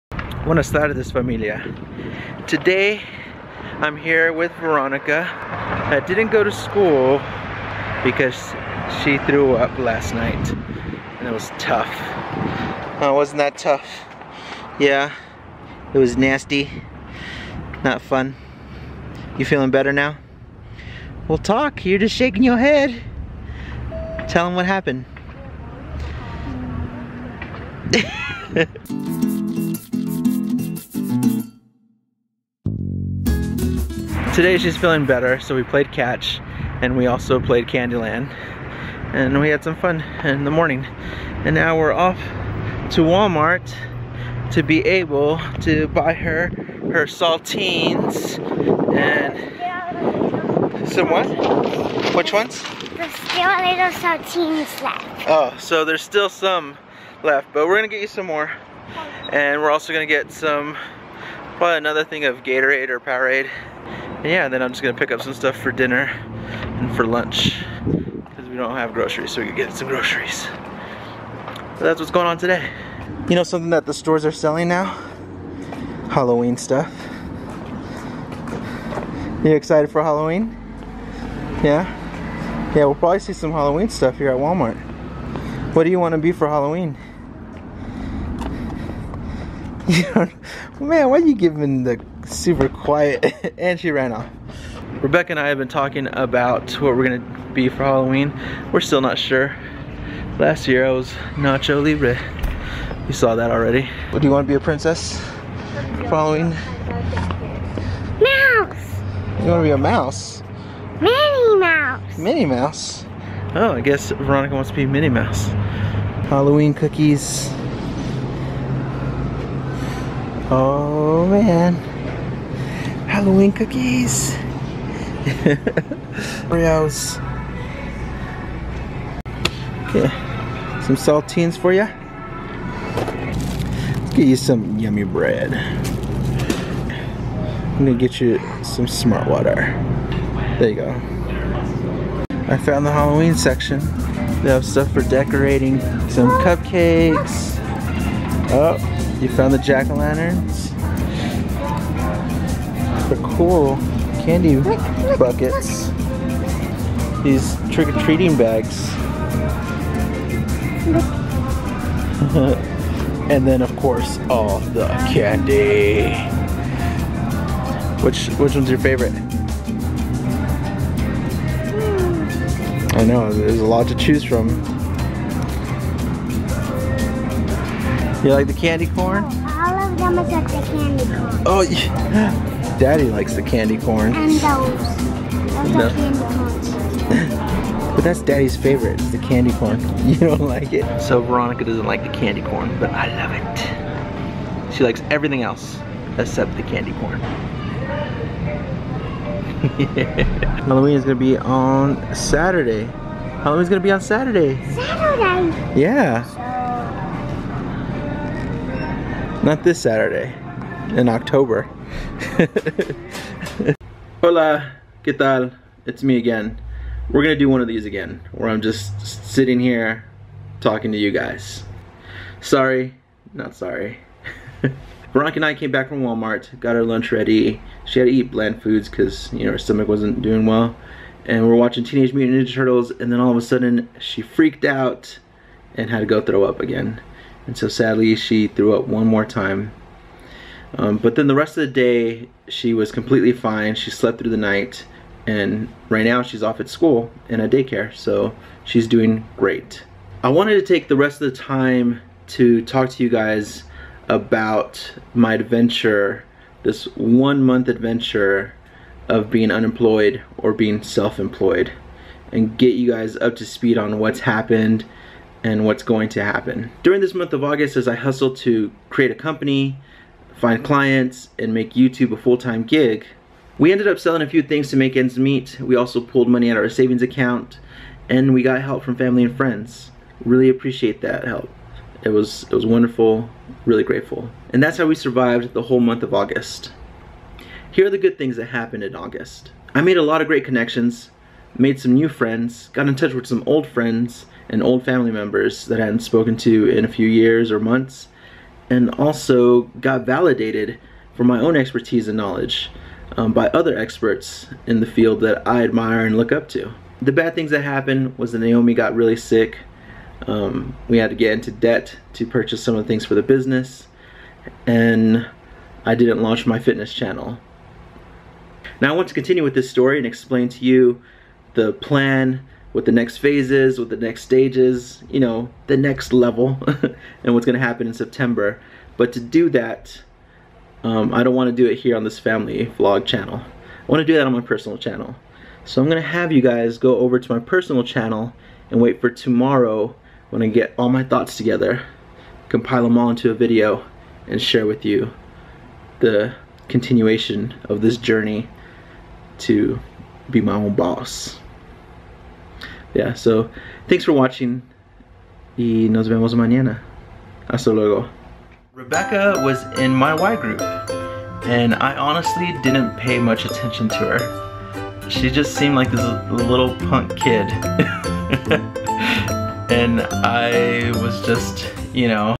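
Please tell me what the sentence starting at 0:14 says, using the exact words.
Yeah, it was nasty, not fun.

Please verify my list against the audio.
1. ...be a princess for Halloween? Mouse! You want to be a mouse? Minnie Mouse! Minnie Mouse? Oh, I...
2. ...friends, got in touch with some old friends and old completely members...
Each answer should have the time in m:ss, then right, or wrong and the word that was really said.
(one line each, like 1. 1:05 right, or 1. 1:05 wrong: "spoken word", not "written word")
1. 1:44 right
2. 4:52 wrong: "family", not "completely".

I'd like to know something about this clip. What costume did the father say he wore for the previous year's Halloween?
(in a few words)
Nacho Libre.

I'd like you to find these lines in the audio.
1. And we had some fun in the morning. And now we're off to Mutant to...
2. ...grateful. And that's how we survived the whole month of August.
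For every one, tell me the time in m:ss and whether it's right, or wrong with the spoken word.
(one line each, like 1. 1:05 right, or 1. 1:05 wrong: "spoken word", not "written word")
1. 0:39 wrong: "Walmart", not "Mutant"
2. 4:43 right.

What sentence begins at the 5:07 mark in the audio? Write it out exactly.
The bad things that happened was that Naomi got really sick.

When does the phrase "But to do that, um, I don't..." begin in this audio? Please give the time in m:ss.
5:28.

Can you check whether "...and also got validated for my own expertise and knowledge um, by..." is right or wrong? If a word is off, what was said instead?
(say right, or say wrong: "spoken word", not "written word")
right.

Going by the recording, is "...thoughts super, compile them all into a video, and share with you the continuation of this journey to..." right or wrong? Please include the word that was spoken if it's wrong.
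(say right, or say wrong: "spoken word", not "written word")
wrong: "together", not "super".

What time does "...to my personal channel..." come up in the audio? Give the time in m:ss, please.
5:37.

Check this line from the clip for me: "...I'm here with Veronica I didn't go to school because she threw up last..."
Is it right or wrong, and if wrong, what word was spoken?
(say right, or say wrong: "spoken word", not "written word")
right.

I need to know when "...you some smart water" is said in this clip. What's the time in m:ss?
2:18.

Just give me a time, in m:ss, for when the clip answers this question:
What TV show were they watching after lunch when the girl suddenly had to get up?
3:51.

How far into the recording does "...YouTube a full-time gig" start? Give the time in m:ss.
4:31.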